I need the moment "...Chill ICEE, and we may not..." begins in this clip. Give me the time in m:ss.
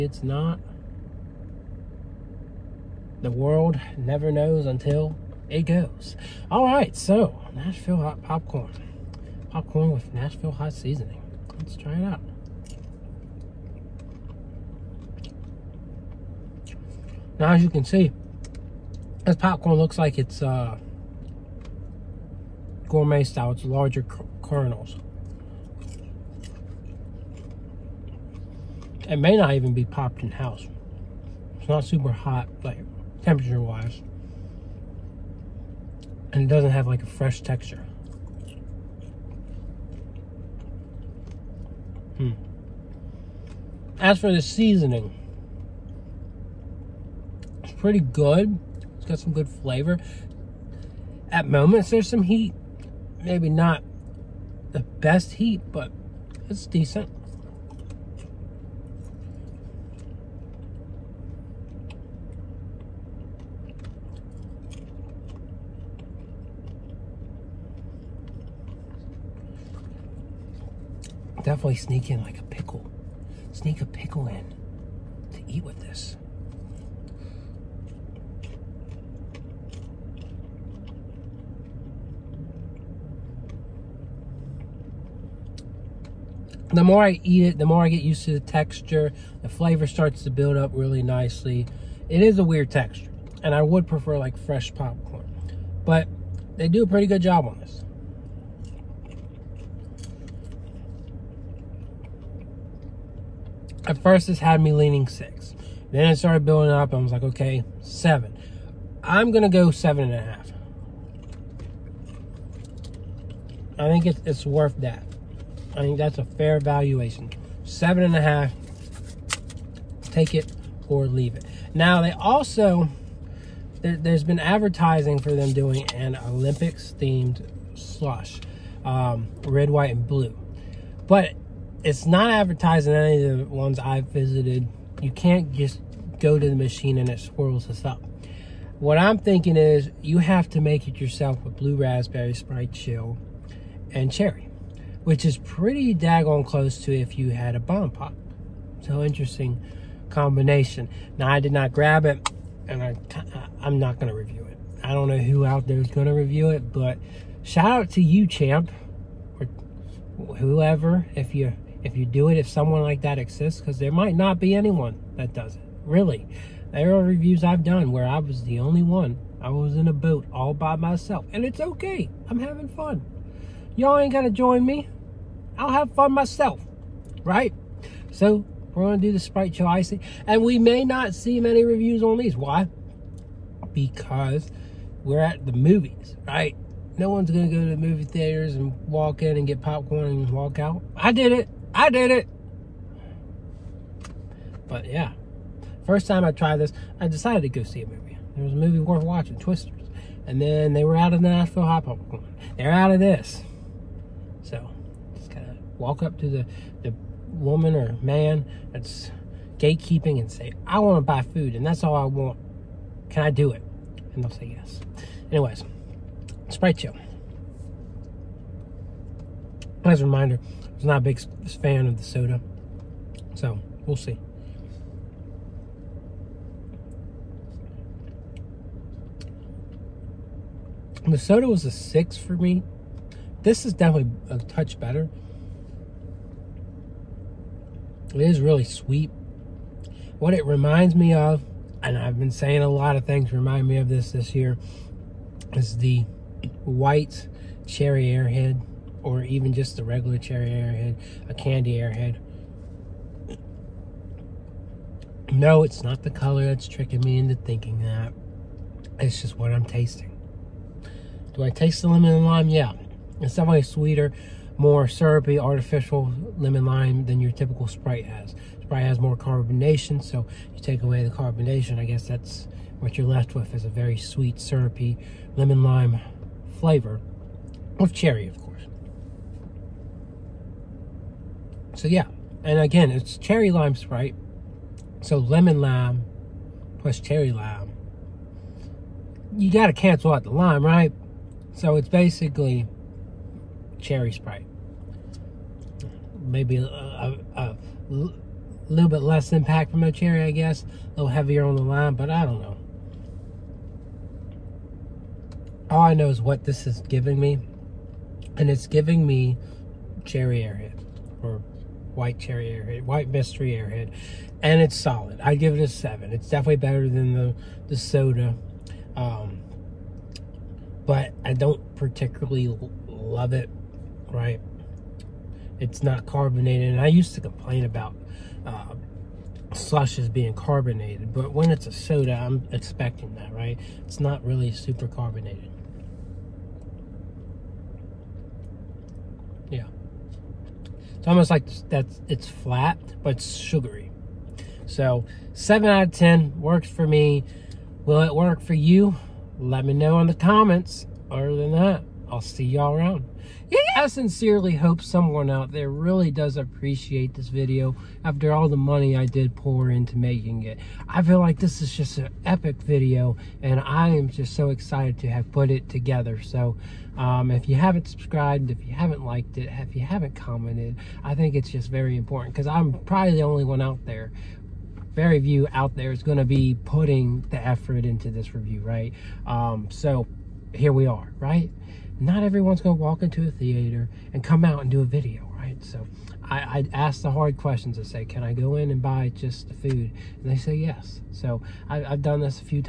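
2:59.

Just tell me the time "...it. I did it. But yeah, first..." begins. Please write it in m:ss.
3:11.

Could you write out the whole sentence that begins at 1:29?
The flavor starts to build up really nicely.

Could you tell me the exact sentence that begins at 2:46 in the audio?
There are reviews I've done where I was the only one.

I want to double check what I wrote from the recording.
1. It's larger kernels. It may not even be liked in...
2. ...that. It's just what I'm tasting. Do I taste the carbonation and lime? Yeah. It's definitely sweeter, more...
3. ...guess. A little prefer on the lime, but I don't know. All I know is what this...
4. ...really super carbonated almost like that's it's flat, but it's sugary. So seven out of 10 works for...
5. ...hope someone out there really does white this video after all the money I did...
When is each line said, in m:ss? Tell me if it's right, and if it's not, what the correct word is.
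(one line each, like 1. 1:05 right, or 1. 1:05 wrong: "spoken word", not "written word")
1. 0:23 wrong: "popped", not "liked"
2. 4:17 wrong: "lemon", not "carbonation"
3. 5:00 wrong: "heavier", not "prefer"
4. 5:34 right
5. 5:54 wrong: "appreciate", not "white".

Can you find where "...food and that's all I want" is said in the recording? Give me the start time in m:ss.
3:31.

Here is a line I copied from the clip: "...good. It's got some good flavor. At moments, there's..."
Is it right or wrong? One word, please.
right.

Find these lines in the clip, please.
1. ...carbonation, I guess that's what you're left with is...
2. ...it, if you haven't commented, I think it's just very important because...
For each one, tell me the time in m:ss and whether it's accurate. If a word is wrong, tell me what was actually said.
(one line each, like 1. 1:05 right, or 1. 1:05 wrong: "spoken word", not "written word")
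1. 4:31 right
2. 6:09 right.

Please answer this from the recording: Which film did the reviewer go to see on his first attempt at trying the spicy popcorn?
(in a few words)
Twisters.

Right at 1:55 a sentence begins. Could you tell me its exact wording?
I think that's a fair valuation.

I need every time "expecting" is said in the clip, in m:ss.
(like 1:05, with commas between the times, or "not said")
5:32.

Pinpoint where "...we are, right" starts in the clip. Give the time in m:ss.
6:20.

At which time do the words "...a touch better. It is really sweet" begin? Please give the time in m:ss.
3:54.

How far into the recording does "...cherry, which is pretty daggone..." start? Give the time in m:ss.
2:24.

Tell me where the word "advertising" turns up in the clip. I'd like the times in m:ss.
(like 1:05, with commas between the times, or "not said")
2:04, 2:12.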